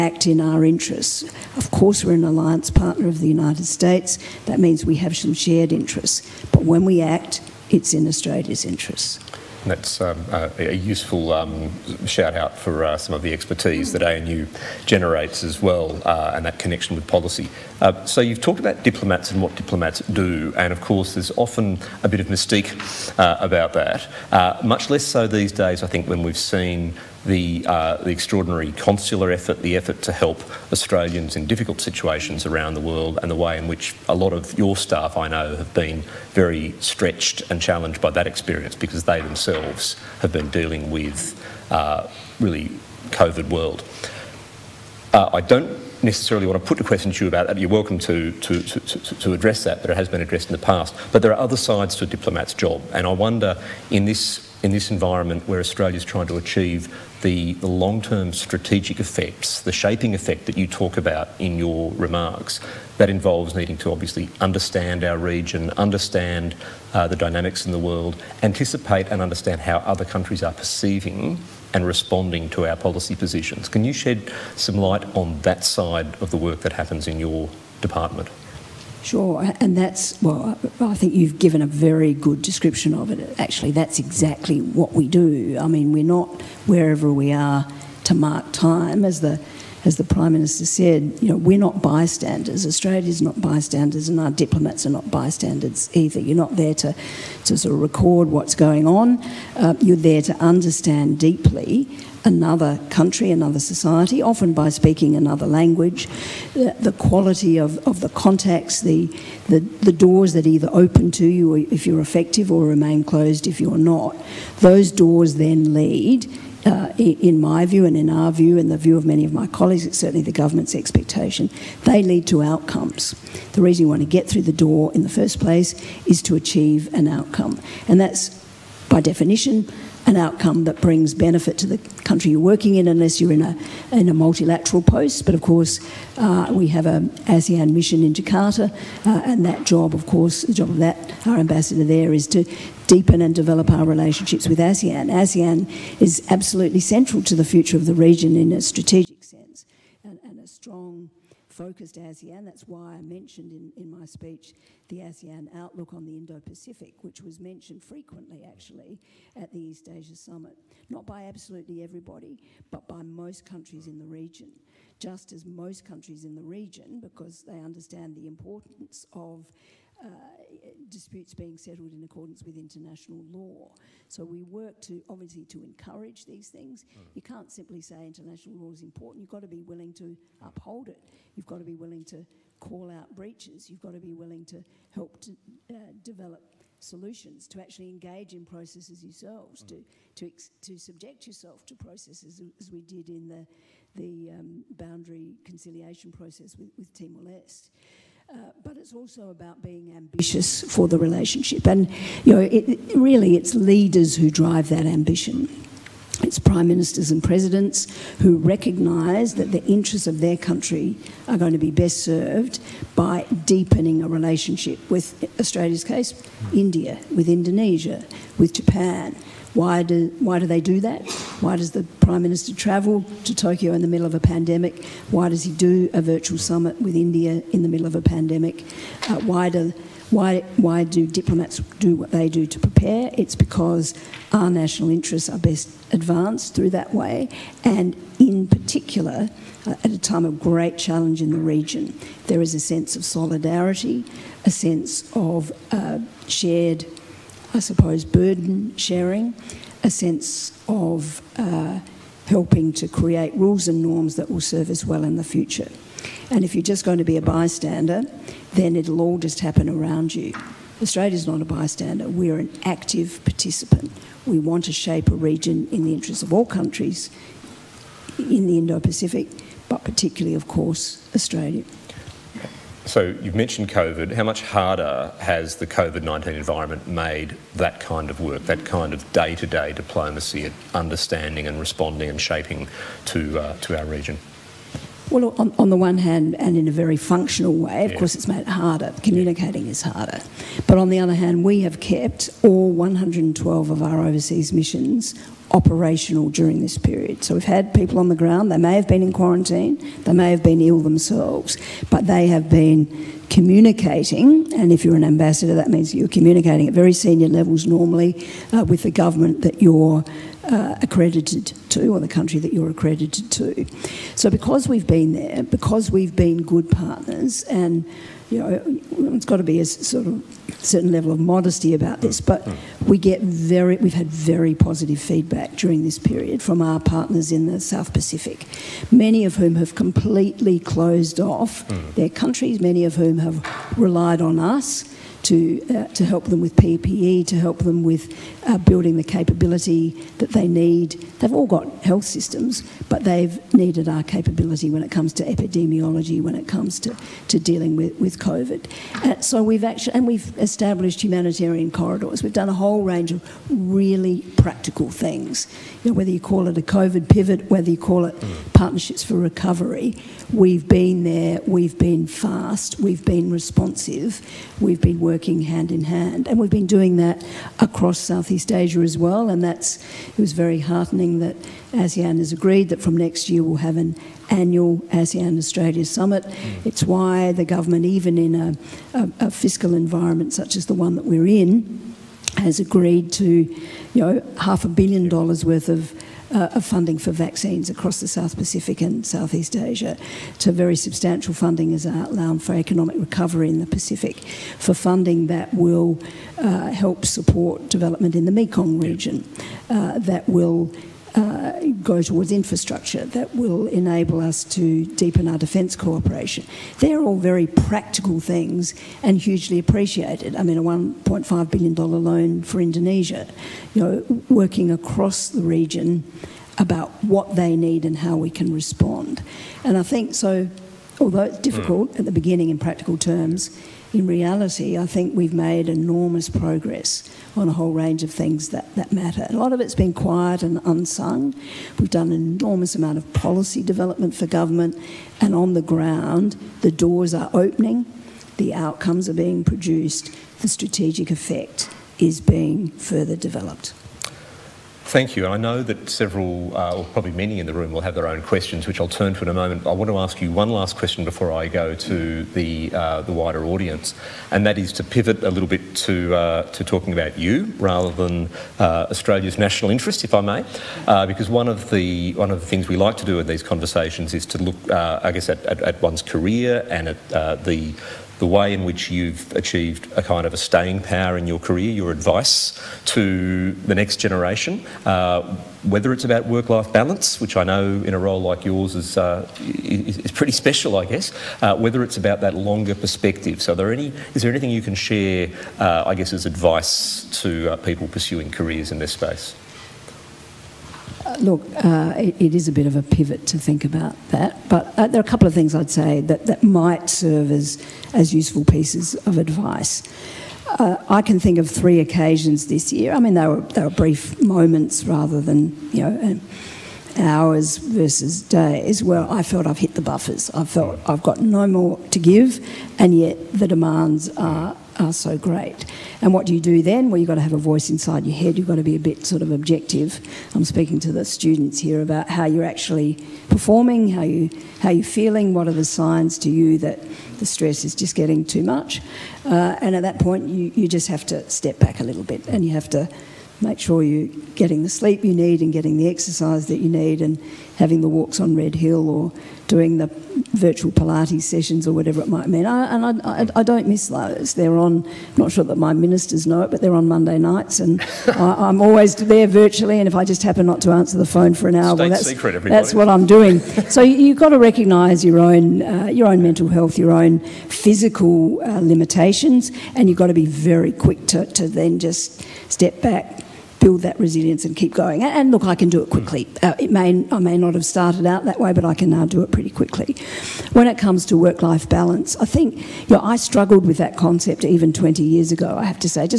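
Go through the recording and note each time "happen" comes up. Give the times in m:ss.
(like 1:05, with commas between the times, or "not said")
1:16, 4:19, 9:10.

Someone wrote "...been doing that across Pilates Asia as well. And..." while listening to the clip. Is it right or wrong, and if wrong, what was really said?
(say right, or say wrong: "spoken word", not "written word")
wrong: "Southeast", not "Pilates".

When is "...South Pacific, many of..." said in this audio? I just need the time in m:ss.
5:27.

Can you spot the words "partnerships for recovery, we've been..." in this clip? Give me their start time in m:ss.
5:58.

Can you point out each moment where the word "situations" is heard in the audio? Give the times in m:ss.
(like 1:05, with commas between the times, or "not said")
0:31.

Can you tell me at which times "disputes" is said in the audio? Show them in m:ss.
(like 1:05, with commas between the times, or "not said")
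2:50.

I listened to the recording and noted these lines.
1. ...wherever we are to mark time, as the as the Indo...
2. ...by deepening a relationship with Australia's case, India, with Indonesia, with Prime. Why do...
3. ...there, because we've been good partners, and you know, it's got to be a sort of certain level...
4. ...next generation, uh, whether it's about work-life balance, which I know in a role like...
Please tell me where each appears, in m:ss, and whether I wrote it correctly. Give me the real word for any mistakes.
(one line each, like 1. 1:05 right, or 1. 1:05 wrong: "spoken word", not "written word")
1. 1:26 wrong: "Prime", not "Indo"
2. 3:32 wrong: "Japan", not "Prime"
3. 5:15 right
4. 7:53 right.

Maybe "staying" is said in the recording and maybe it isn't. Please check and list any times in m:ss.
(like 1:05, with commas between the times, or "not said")
7:50.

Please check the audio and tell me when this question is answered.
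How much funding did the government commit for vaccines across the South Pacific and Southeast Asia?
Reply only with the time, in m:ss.
6:24.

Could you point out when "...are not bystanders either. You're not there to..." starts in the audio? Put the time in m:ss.
1:34.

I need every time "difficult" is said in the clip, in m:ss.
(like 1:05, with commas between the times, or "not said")
0:31, 7:01.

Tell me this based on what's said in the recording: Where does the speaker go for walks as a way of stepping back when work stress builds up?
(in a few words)
Red Hill.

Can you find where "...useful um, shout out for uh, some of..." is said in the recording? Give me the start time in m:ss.
0:10.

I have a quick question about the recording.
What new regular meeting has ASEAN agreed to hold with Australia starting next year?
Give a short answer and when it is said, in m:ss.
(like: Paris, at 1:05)
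annual ASEAN Australia Summit, at 6:14.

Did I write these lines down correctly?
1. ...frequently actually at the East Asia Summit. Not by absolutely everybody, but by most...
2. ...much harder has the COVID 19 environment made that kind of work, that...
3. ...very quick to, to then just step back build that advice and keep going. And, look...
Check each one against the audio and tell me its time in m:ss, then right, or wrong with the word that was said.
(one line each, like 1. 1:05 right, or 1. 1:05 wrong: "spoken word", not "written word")
1. 2:37 right
2. 4:34 right
3. 9:20 wrong: "resilience", not "advice".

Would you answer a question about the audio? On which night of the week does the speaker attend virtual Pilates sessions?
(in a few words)
Monday.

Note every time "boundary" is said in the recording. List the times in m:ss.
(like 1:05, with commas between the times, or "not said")
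3:14.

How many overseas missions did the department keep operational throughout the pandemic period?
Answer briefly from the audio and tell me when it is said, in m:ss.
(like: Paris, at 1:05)
112, at 4:52.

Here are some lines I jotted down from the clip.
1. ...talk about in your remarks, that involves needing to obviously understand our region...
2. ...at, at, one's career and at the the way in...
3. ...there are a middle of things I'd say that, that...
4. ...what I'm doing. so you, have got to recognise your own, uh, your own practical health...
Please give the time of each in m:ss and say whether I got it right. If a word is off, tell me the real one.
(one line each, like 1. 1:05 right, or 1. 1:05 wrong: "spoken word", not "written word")
1. 1:00 right
2. 7:45 right
3. 8:14 wrong: "couple", not "middle"
4. 9:12 wrong: "mental", not "practical".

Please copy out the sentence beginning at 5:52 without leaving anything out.
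We've done a whole range of really practical things.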